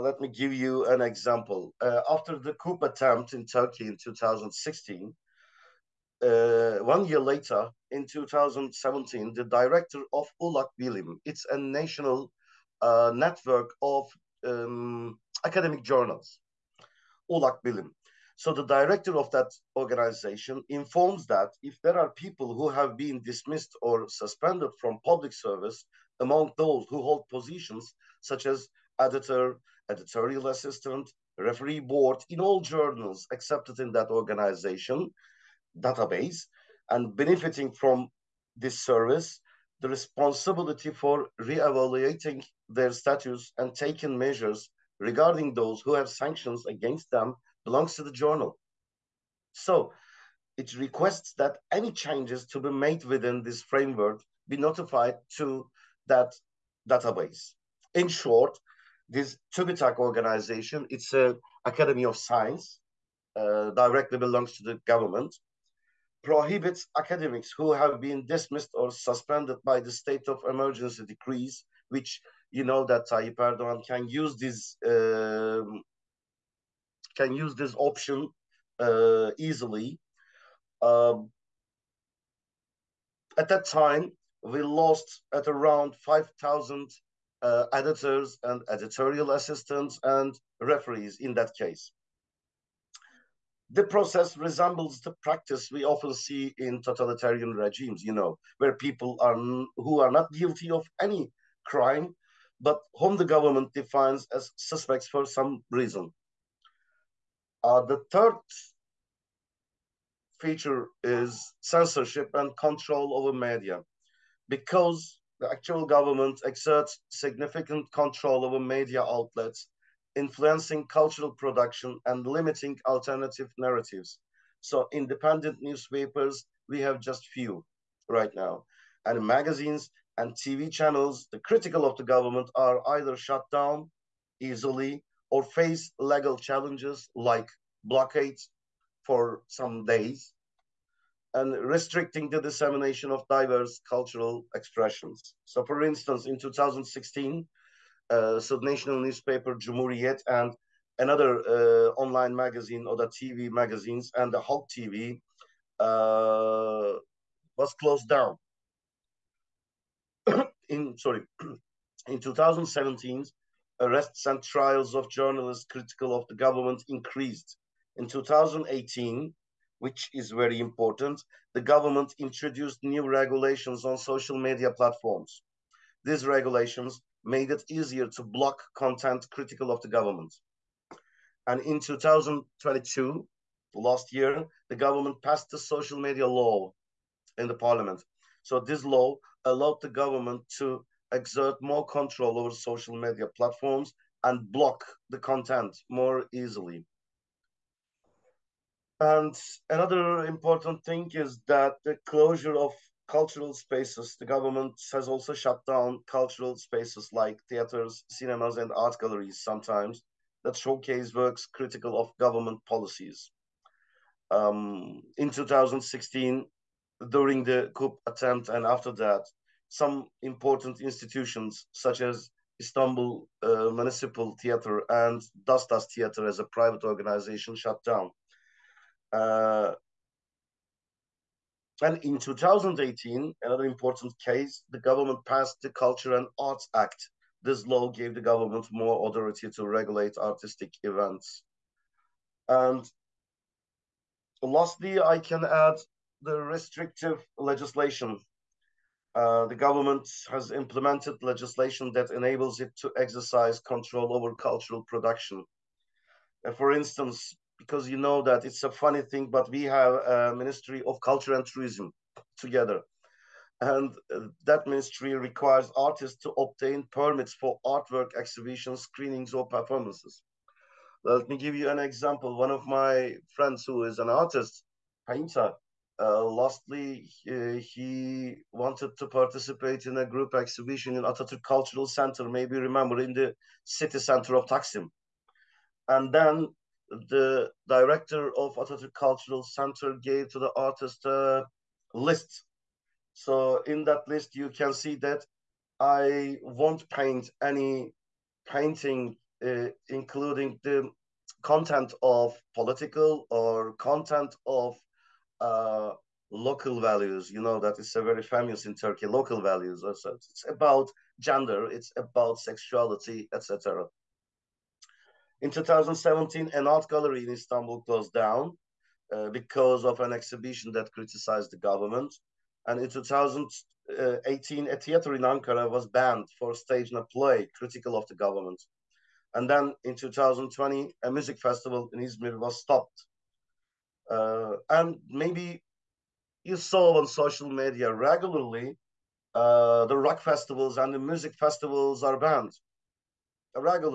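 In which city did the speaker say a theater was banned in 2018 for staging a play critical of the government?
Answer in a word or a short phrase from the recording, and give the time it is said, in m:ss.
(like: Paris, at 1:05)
Ankara, at 5:25.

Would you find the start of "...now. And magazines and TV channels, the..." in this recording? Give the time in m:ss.
2:08.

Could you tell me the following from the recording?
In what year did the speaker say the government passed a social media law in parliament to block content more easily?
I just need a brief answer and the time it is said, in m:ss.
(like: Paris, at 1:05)
2022, at 3:01.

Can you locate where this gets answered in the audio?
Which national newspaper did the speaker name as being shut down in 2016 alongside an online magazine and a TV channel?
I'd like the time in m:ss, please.
2:29.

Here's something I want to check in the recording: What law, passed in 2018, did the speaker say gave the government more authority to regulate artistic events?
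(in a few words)
Culture and Arts Act.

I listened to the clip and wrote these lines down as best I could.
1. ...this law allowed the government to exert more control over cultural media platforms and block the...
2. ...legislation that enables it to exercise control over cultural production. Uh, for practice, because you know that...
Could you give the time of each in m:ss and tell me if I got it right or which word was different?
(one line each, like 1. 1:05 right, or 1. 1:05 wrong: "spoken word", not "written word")
1. 3:08 wrong: "social", not "cultural"
2. 4:11 wrong: "instance", not "practice".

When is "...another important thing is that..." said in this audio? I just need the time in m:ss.
3:19.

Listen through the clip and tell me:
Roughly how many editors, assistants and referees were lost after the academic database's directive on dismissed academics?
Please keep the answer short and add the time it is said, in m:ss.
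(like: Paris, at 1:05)
5,000, at 1:25.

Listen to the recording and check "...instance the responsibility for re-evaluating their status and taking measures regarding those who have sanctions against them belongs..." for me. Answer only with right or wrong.
wrong.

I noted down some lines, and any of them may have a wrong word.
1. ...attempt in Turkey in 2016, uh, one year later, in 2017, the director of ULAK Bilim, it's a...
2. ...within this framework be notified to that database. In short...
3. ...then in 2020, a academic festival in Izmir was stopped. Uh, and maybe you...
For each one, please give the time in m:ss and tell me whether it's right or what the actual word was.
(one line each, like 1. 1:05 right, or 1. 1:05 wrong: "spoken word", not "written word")
1. 0:02 right
2. 0:53 right
3. 5:29 wrong: "music", not "academic".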